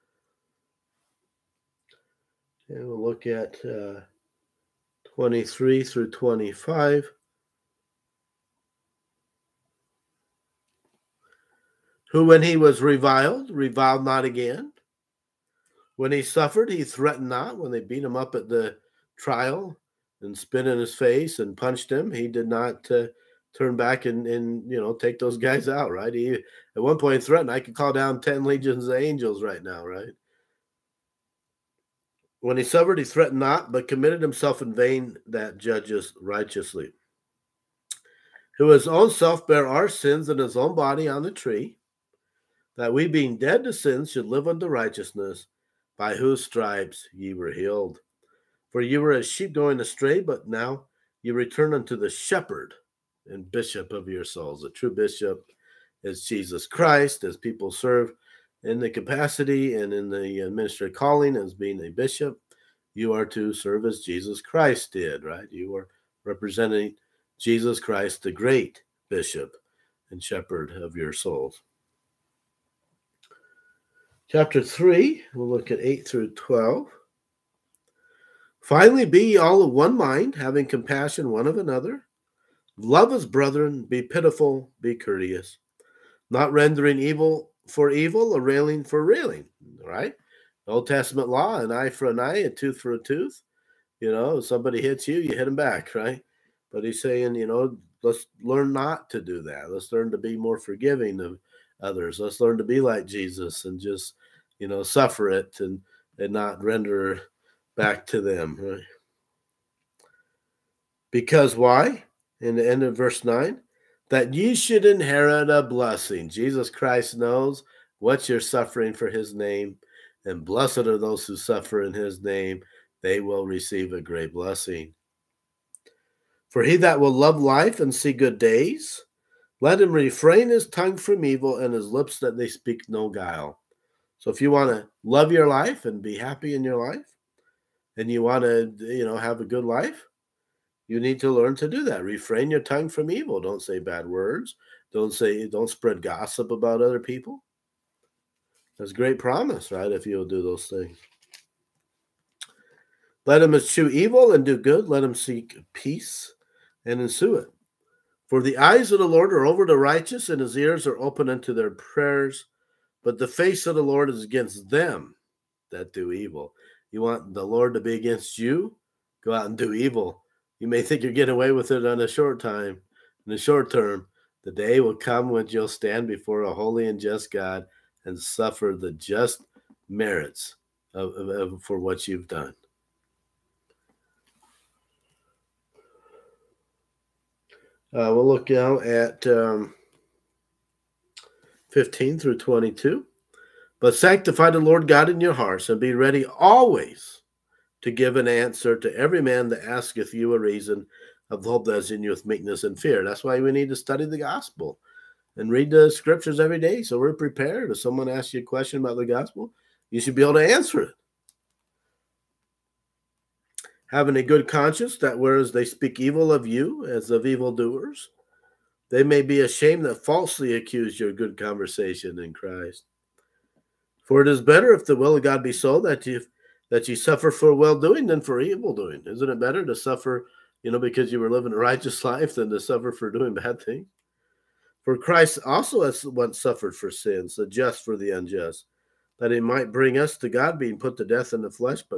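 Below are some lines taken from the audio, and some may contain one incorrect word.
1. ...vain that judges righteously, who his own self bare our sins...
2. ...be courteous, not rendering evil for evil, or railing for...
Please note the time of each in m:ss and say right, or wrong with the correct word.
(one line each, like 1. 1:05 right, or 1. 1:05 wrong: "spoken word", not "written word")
1. 0:34 right
2. 1:24 right.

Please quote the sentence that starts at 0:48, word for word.
For ye were as sheep going astray, but now ye return unto the shepherd and bishop of your souls.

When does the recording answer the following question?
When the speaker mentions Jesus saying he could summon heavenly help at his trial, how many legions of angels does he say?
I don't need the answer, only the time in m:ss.
0:28.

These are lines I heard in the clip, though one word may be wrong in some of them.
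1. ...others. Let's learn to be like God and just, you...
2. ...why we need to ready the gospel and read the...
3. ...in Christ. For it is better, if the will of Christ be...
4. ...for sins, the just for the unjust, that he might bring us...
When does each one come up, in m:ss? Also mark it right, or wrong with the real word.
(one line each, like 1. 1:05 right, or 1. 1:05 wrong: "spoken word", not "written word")
1. 1:41 wrong: "Jesus", not "God"
2. 3:23 wrong: "study", not "ready"
3. 3:42 wrong: "God", not "Christ"
4. 3:56 right.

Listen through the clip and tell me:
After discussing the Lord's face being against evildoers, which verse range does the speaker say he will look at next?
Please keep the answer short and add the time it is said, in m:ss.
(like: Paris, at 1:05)
15 through 22, at 3:11.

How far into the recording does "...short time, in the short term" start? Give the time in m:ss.
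2:52.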